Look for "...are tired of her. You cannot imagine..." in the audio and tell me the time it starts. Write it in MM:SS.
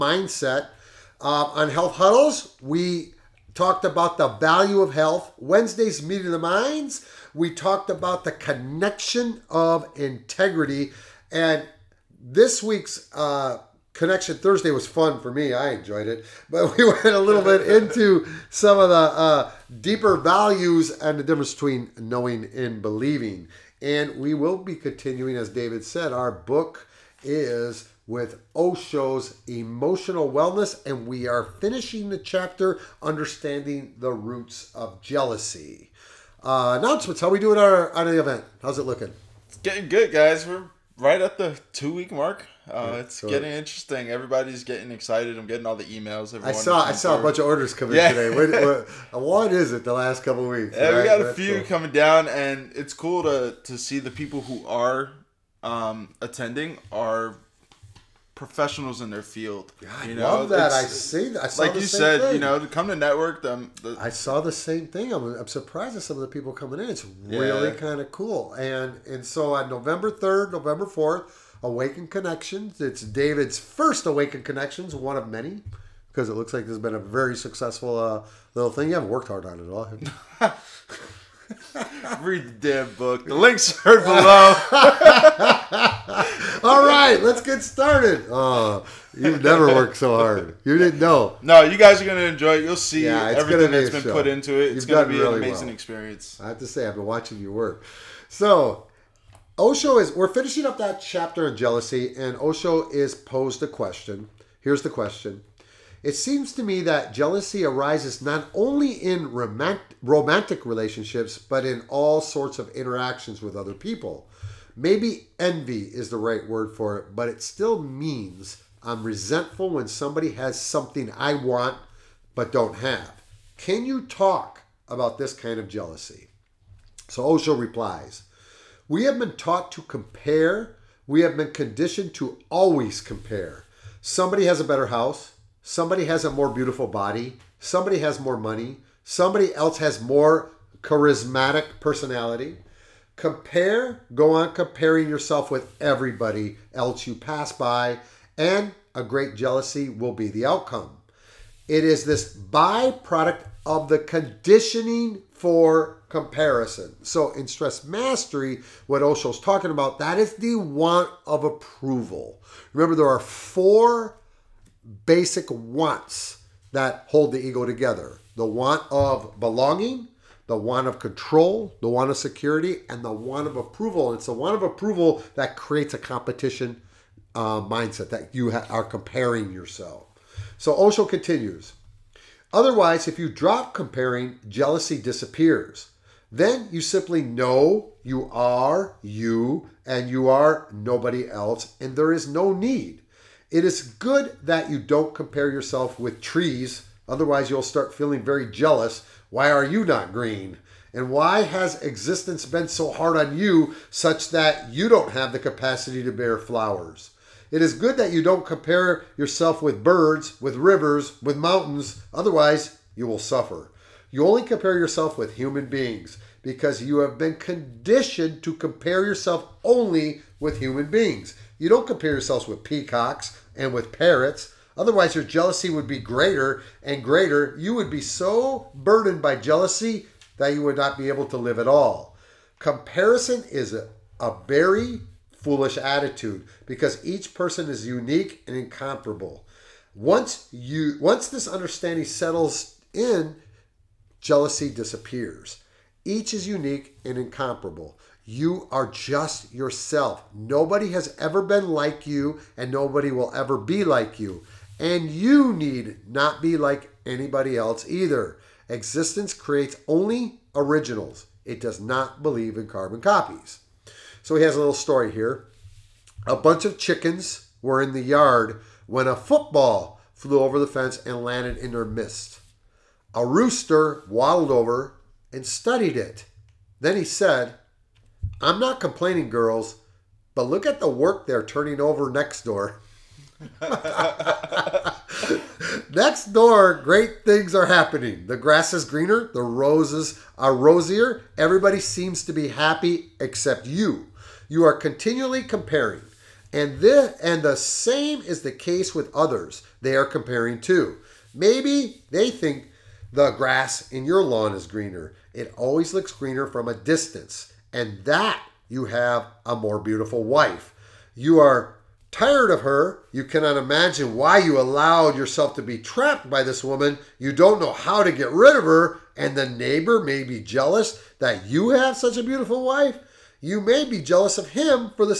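05:11.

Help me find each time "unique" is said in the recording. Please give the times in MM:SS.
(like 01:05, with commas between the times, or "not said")
03:57, 04:06.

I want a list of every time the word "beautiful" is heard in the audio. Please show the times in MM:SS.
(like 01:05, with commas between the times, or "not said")
02:16, 05:09, 05:22.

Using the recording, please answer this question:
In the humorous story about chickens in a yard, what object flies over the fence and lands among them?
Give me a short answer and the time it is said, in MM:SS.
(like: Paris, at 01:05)
A football, at 04:29.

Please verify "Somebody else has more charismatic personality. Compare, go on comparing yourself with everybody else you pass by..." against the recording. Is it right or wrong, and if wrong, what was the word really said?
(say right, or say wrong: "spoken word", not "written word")
right.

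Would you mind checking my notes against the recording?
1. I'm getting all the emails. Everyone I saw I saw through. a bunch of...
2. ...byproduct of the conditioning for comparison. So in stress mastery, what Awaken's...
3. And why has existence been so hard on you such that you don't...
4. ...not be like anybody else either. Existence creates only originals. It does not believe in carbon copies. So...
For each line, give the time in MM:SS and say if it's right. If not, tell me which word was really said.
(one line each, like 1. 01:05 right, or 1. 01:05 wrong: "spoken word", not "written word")
1. 00:45 right
2. 02:32 wrong: "Osho", not "Awaken"
3. 03:20 right
4. 04:16 right.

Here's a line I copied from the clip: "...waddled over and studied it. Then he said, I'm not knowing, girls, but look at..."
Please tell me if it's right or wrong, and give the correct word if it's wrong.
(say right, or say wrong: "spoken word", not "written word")
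wrong: "complaining", not "knowing".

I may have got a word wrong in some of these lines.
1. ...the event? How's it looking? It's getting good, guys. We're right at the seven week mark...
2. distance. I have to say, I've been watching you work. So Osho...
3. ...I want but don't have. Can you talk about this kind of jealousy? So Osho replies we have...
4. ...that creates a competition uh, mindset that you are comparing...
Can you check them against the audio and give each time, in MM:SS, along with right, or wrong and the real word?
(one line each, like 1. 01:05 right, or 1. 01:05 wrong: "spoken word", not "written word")
1. 00:38 wrong: "two", not "seven"
2. 01:35 wrong: "experience", not "distance"
3. 02:01 right
4. 02:55 right.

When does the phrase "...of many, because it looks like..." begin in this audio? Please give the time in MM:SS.
01:15.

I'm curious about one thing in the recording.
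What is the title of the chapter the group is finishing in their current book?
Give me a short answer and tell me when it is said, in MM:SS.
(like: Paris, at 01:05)
Understanding the roots of jealousy, at 00:33.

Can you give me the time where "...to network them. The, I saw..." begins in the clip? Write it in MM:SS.
01:02.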